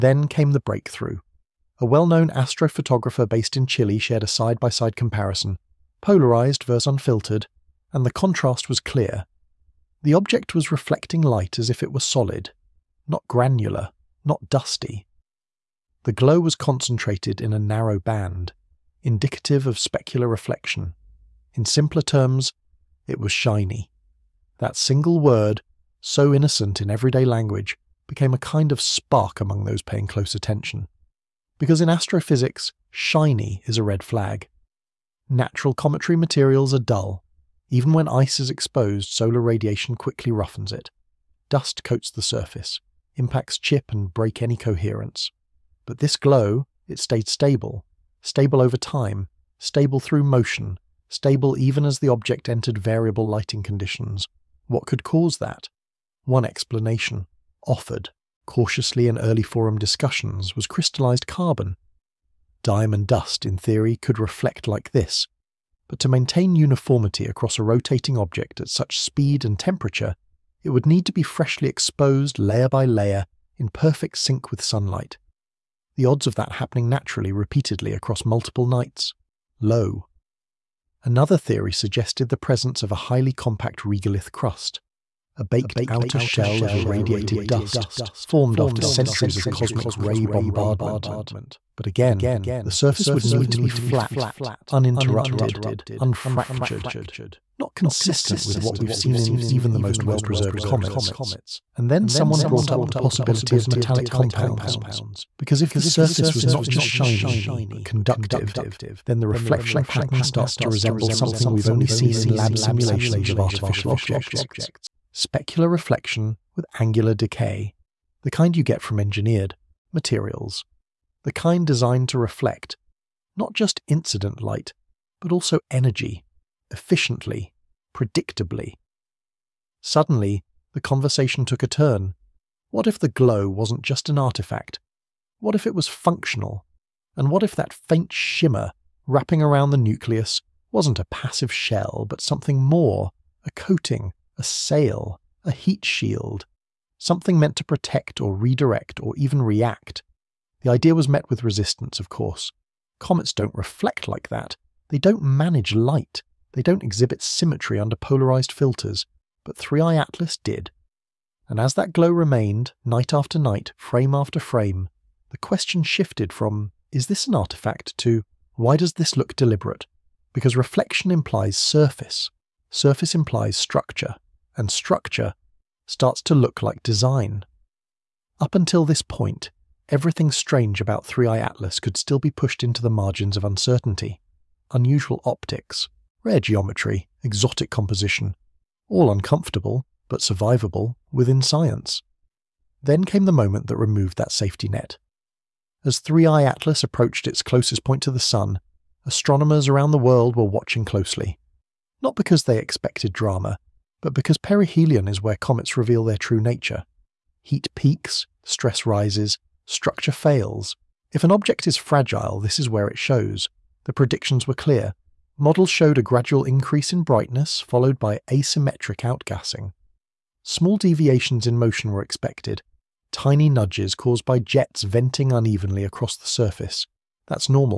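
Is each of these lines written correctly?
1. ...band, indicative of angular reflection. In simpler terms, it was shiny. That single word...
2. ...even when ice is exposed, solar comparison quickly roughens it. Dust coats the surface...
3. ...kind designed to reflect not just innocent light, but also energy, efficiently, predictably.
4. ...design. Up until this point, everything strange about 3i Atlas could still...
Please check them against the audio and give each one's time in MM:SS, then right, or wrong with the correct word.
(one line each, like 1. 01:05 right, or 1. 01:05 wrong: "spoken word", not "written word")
1. 00:17 wrong: "specular", not "angular"
2. 00:37 wrong: "radiation", not "comparison"
3. 02:01 wrong: "incident", not "innocent"
4. 02:56 right.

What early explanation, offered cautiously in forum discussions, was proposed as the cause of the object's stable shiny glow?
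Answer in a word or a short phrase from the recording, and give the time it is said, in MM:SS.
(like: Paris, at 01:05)
Crystallized carbon, at 01:00.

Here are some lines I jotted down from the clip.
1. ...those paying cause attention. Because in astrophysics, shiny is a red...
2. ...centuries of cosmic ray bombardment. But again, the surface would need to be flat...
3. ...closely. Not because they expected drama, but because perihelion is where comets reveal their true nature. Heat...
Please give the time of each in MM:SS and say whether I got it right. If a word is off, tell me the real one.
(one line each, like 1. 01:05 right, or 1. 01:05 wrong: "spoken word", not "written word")
1. 00:29 wrong: "close", not "cause"
2. 01:28 right
3. 03:20 right.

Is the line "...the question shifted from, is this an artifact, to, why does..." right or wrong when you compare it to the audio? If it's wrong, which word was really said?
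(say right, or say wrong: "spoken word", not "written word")
right.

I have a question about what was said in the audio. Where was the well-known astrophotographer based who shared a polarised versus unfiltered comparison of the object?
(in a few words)
Chile.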